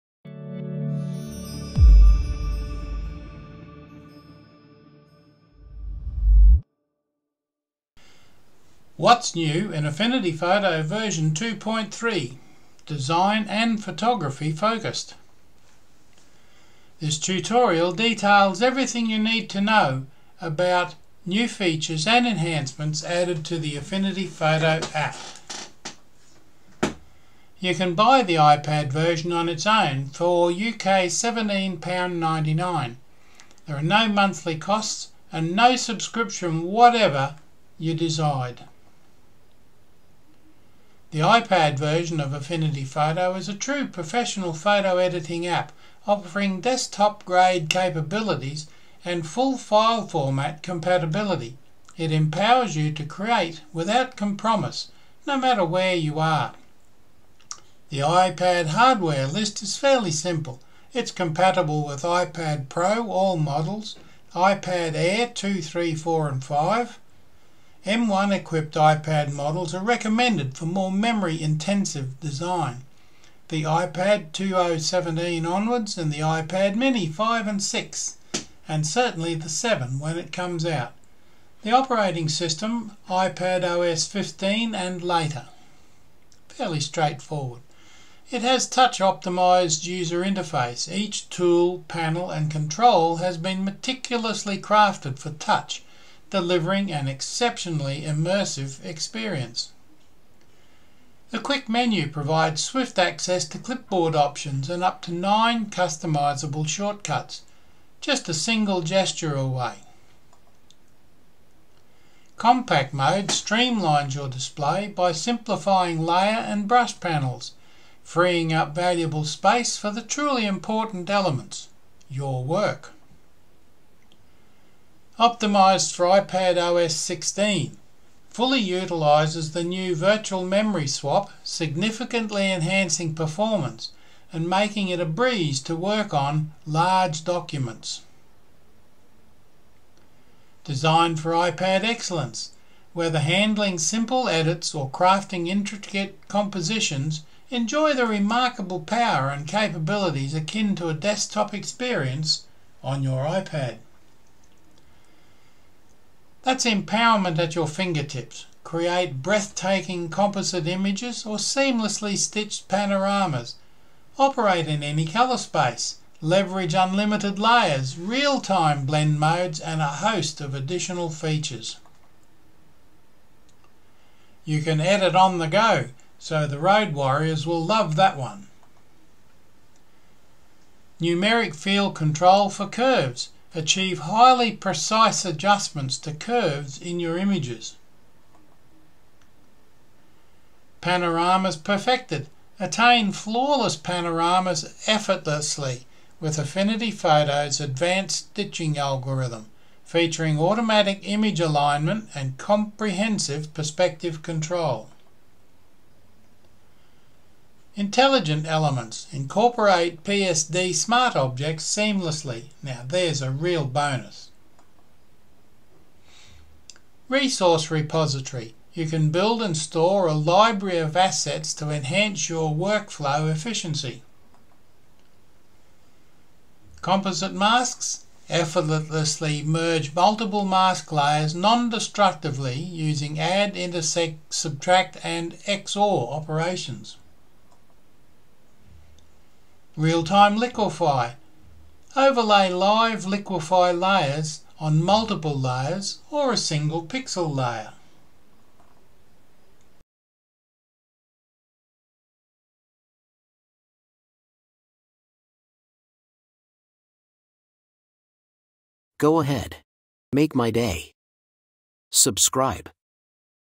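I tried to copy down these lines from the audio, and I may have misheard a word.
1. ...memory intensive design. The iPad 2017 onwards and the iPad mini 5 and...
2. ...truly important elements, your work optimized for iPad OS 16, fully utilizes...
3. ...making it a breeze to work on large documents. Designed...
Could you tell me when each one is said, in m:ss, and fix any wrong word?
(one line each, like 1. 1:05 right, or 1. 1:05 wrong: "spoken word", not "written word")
1. 1:10 right
2. 2:00 right
3. 2:14 right.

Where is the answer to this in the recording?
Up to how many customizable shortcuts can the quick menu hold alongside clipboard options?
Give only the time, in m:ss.
1:45.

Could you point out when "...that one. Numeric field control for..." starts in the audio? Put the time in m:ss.
2:57.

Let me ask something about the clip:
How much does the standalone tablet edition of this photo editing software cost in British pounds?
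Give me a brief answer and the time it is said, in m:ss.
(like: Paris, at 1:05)
£17.99, at 0:30.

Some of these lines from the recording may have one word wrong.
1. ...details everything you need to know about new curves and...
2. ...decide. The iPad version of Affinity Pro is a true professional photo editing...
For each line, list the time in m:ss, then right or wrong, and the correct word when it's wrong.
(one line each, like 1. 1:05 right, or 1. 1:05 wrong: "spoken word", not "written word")
1. 0:17 wrong: "features", not "curves"
2. 0:37 wrong: "Photo", not "Pro".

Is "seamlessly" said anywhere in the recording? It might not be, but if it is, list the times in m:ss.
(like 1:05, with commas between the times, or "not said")
2:41, 3:31.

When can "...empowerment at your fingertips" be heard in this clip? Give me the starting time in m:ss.
2:36.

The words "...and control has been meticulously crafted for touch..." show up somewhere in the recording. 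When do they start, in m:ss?
1:32.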